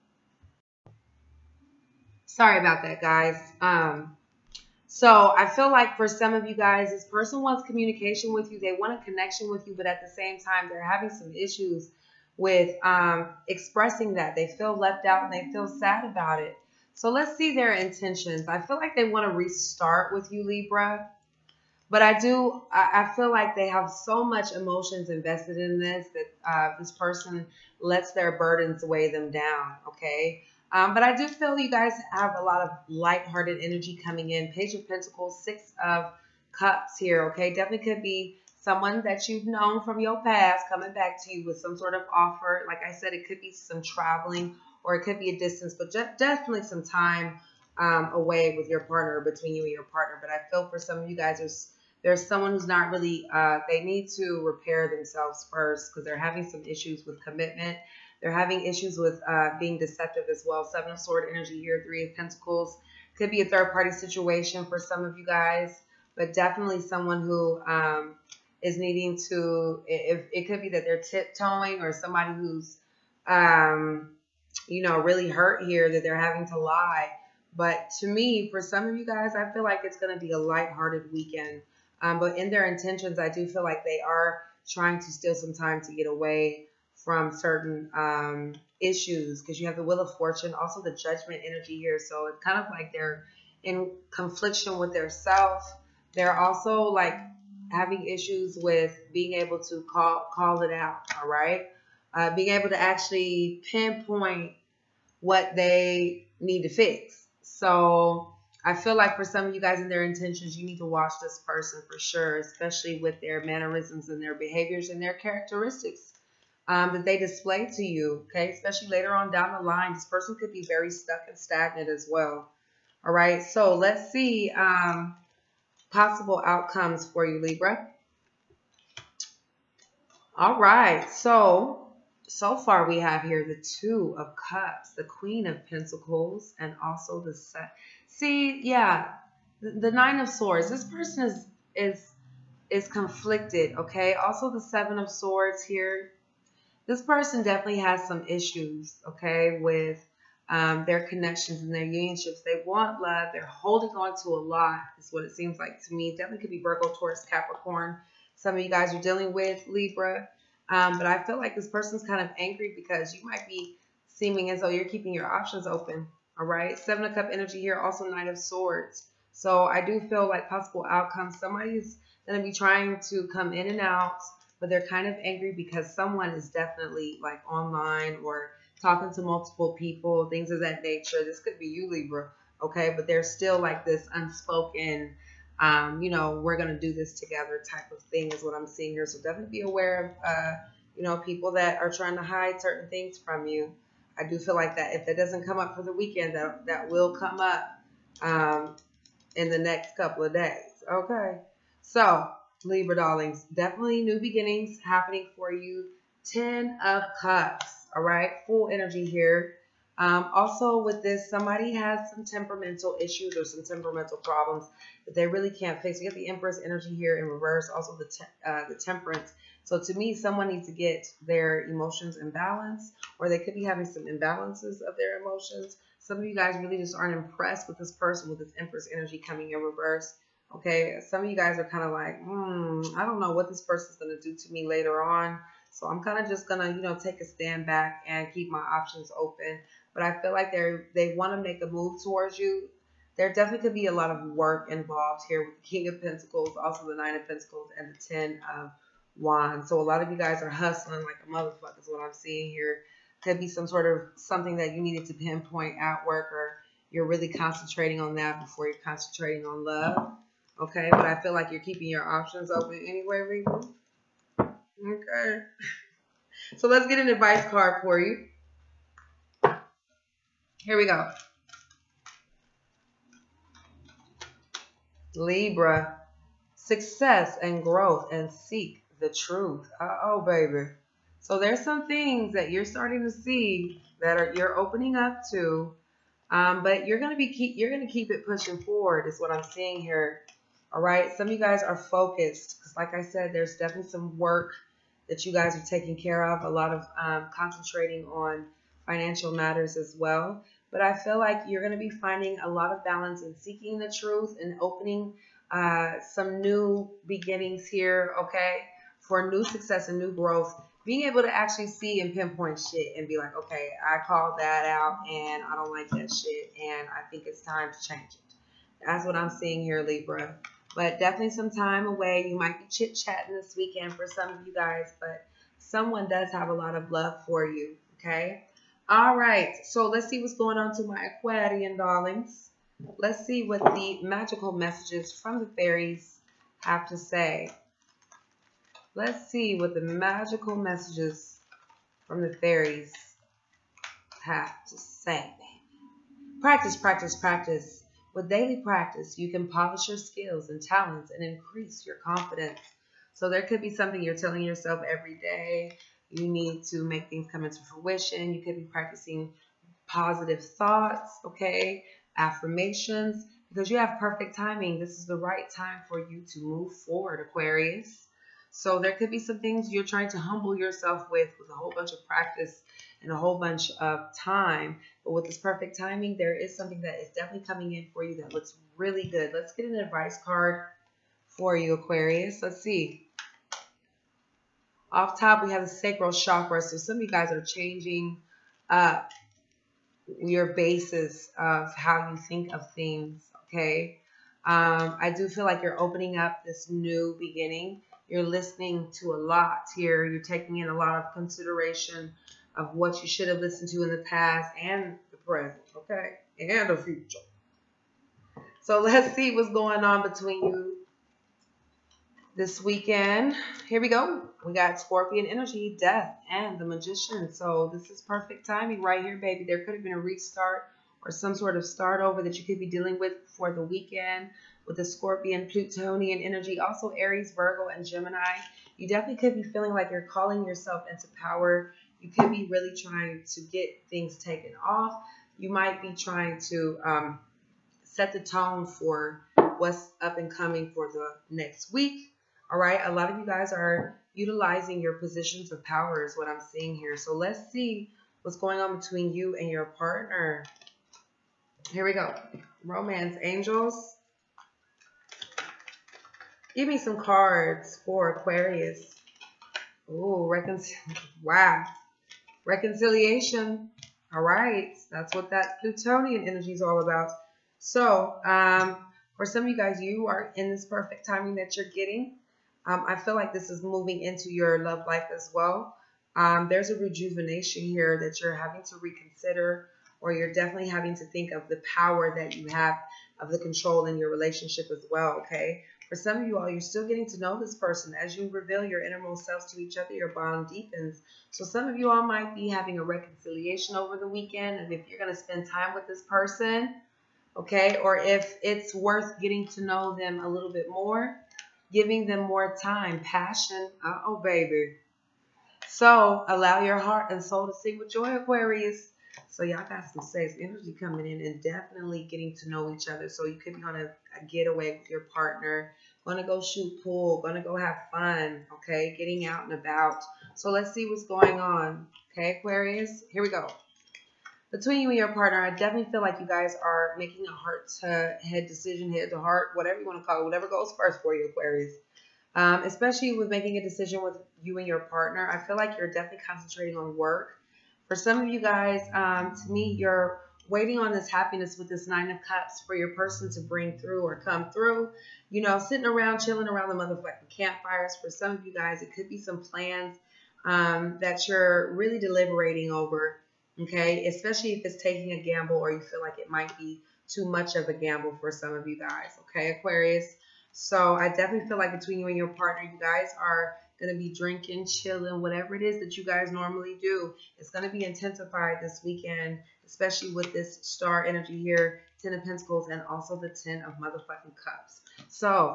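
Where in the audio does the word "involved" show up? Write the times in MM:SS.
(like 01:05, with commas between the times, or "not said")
04:04.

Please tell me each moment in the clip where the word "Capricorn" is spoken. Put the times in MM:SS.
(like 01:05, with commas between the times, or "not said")
02:37.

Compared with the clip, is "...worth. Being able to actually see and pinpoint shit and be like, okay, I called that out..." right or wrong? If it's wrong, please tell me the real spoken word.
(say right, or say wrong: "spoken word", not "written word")
wrong: "growth", not "worth".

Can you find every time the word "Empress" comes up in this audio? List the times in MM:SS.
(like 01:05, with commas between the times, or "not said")
03:36, 03:48.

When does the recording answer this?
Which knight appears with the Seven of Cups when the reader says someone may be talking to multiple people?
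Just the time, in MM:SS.
02:48.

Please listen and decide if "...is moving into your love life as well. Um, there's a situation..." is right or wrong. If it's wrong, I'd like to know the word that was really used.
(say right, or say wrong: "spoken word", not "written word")
wrong: "rejuvenation", not "situation".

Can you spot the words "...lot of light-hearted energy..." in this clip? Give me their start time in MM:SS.
00:32.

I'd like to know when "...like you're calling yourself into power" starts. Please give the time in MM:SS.
07:09.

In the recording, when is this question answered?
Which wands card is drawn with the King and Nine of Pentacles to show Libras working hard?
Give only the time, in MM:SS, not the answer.
04:08.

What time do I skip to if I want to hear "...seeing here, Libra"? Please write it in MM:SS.
05:19.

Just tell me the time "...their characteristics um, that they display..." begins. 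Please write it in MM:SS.
01:55.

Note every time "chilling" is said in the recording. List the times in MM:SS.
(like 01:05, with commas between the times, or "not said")
09:06, 09:24.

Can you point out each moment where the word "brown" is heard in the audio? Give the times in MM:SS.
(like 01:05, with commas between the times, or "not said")
not said.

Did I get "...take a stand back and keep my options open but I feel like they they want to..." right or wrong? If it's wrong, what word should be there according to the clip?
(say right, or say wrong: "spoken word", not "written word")
right.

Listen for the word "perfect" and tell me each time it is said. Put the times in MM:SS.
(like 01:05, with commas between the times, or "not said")
06:03, 06:15, 06:58, 07:50.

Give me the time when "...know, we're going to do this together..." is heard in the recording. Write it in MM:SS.
03:06.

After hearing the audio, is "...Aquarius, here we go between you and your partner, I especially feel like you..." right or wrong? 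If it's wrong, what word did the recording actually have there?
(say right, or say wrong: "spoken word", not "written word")
wrong: "definitely", not "especially".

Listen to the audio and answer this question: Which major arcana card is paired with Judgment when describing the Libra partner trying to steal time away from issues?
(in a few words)
Wheel of Fortune.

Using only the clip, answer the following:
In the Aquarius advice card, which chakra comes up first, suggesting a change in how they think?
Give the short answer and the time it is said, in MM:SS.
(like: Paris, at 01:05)
Sacral chakra, at 06:25.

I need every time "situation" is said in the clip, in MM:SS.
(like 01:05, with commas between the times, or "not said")
01:03.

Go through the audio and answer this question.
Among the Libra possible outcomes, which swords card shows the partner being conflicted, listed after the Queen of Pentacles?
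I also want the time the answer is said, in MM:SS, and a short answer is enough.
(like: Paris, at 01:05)
Nine of Swords, at 02:19.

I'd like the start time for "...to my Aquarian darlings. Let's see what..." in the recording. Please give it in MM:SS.
05:30.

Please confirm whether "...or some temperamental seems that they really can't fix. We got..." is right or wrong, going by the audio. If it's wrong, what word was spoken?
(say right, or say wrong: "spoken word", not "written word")
wrong: "problems", not "seems".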